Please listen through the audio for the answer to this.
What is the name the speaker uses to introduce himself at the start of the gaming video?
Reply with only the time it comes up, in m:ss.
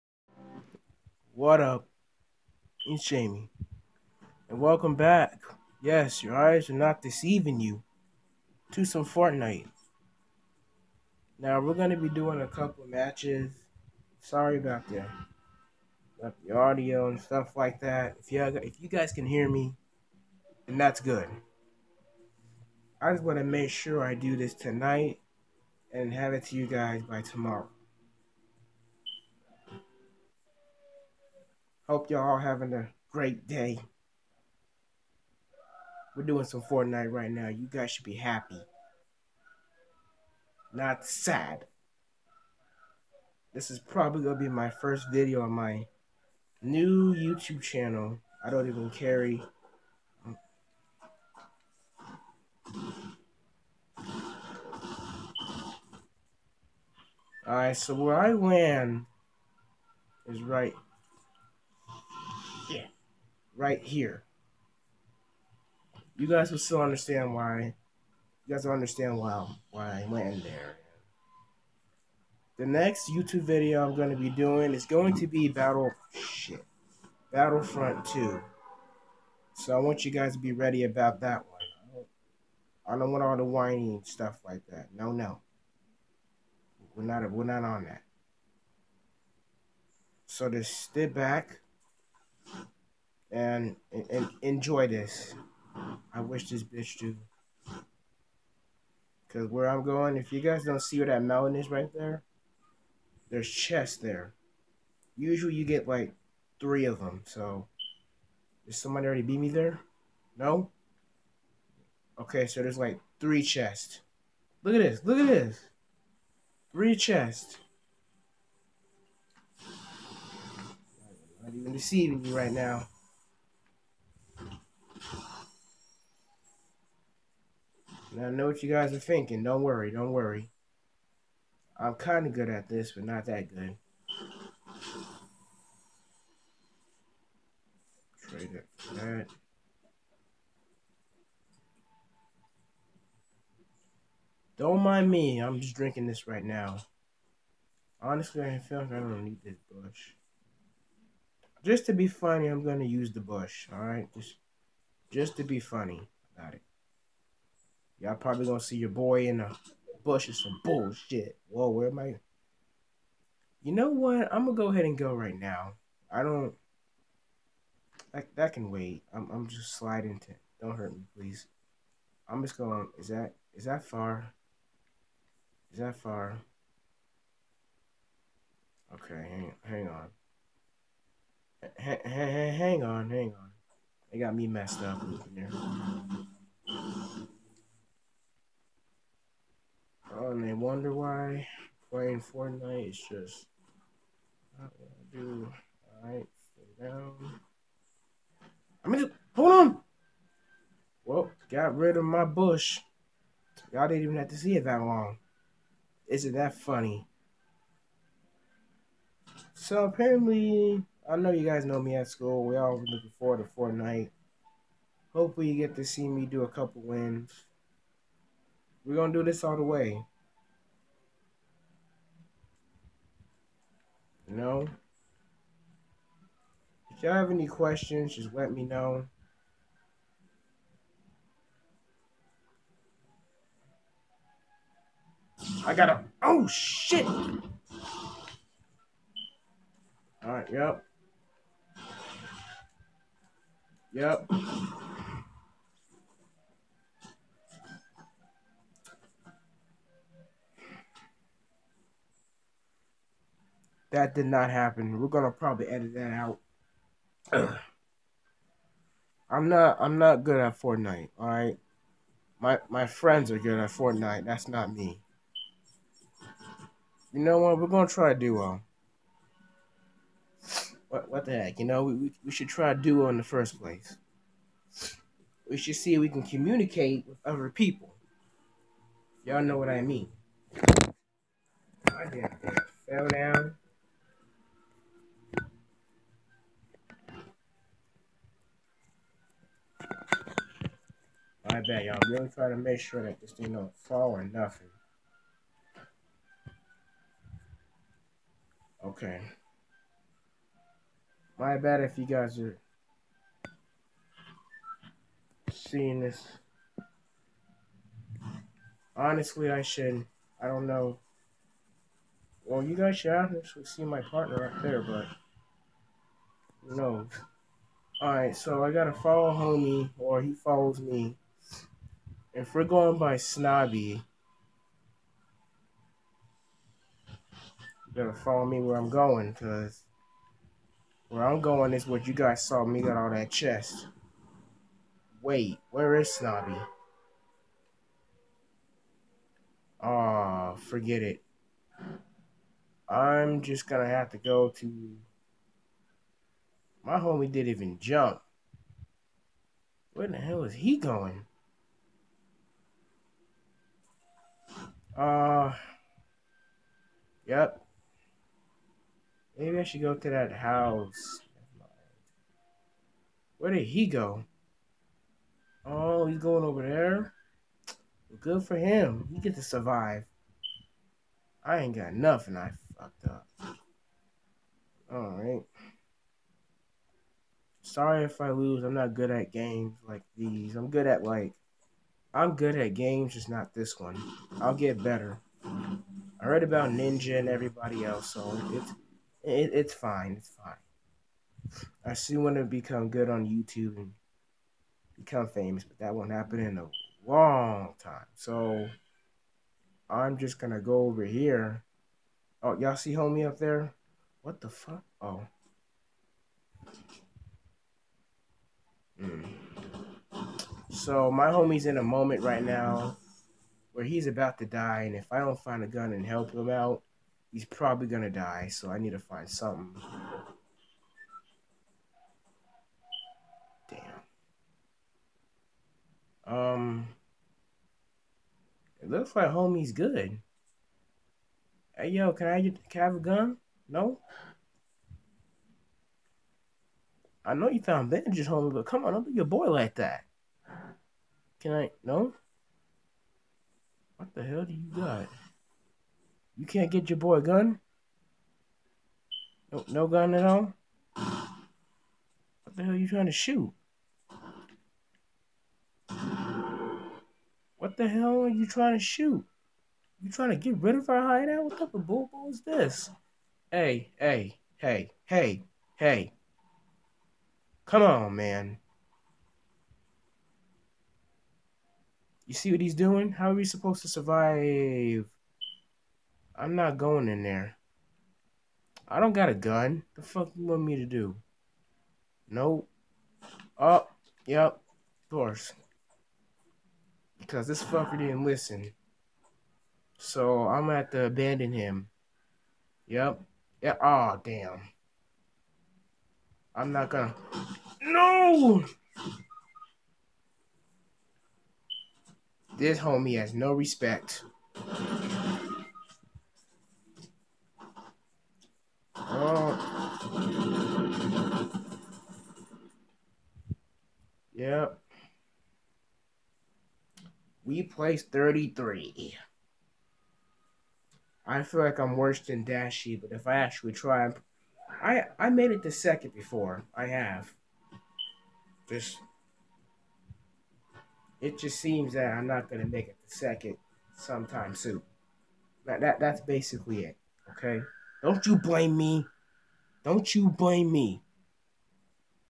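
0:03.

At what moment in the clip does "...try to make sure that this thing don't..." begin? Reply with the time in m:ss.
4:52.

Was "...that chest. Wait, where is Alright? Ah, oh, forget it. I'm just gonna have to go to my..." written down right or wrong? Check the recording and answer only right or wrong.
wrong.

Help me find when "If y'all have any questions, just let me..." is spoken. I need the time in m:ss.
3:46.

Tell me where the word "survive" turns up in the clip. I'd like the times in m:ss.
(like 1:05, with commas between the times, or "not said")
6:09, 7:53.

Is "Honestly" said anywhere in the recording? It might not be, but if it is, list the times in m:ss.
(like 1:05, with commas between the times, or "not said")
2:28, 5:08.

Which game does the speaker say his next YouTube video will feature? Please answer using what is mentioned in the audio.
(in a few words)
Battlefront 2.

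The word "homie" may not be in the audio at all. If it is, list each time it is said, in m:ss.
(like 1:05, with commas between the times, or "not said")
5:19, 5:46, 6:42, 6:51, 7:09, 7:18, 8:22.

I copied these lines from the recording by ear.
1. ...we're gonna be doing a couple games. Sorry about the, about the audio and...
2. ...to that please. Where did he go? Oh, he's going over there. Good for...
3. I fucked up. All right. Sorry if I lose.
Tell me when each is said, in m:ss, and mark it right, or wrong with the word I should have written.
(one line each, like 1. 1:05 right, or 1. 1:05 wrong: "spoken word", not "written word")
1. 0:11 wrong: "matches", not "games"
2. 5:59 wrong: "house", not "please"
3. 6:12 right.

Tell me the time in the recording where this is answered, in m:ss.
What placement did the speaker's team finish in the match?
8:38.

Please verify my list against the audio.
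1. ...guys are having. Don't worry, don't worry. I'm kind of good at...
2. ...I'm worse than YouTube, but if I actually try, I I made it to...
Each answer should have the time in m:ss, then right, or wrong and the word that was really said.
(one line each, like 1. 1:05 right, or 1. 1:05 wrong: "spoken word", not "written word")
1. 2:08 wrong: "thinking", not "having"
2. 8:41 wrong: "Dashy", not "YouTube".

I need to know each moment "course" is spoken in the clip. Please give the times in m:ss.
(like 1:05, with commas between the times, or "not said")
8:05.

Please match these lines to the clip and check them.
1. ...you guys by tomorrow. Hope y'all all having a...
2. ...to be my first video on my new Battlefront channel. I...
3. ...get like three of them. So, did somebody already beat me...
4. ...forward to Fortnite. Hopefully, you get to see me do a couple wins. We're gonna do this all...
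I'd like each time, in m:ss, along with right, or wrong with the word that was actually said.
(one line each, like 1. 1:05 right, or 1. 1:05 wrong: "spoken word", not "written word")
1. 0:26 right
2. 0:44 wrong: "YouTube", not "Battlefront"
3. 1:45 right
4. 3:33 right.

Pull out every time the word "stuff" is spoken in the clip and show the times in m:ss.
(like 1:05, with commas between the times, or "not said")
0:17, 1:24.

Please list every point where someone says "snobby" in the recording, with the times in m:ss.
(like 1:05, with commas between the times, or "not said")
5:23, 5:36.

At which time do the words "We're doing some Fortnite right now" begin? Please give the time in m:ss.
0:36.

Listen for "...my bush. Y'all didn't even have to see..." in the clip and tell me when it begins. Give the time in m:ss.
3:22.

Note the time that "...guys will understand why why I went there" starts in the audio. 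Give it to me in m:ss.
1:08.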